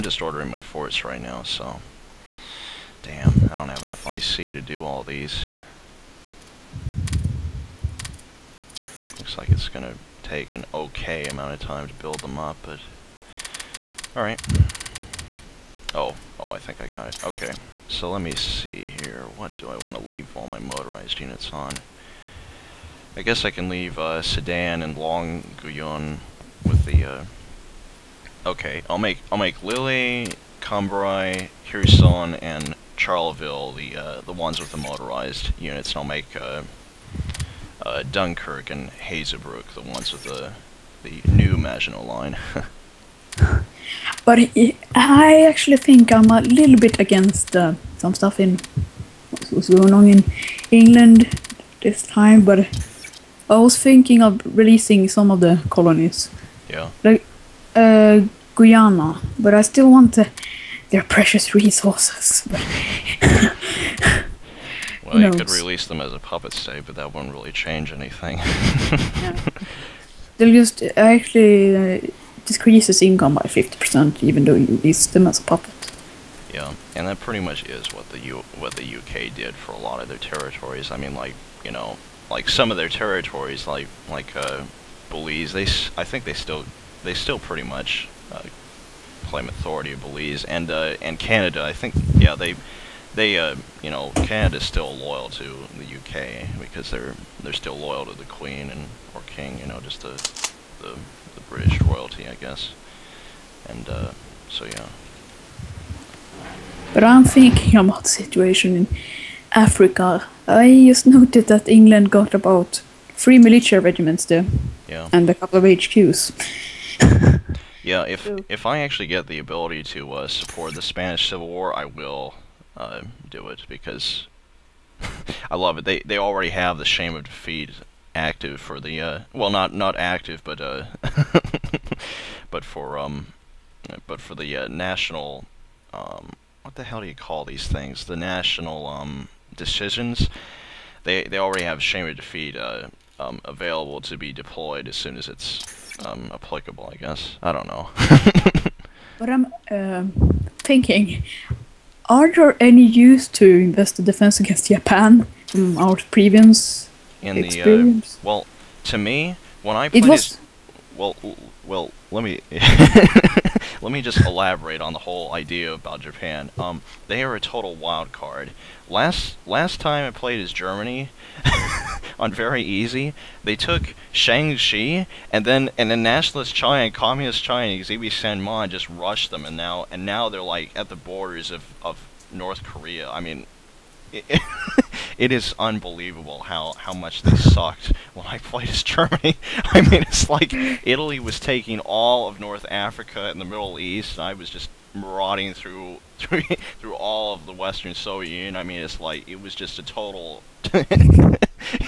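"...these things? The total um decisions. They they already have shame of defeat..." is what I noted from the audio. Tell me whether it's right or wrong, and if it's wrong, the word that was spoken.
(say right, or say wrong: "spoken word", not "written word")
wrong: "national", not "total".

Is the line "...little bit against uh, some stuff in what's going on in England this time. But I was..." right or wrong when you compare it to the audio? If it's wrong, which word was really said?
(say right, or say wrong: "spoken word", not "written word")
right.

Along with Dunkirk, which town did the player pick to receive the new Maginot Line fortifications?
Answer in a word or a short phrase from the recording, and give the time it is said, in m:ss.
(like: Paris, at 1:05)
Hazebrouck, at 0:38.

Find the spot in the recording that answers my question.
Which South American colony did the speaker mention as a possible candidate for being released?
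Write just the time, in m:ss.
0:58.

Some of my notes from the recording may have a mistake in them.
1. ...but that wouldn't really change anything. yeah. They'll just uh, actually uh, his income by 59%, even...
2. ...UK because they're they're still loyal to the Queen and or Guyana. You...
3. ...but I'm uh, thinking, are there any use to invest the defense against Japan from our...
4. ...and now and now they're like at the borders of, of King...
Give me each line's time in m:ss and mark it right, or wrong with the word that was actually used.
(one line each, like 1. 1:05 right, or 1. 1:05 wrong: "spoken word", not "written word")
1. 1:06 wrong: "50", not "59"
2. 1:35 wrong: "King", not "Guyana"
3. 2:29 right
4. 2:59 wrong: "North", not "King".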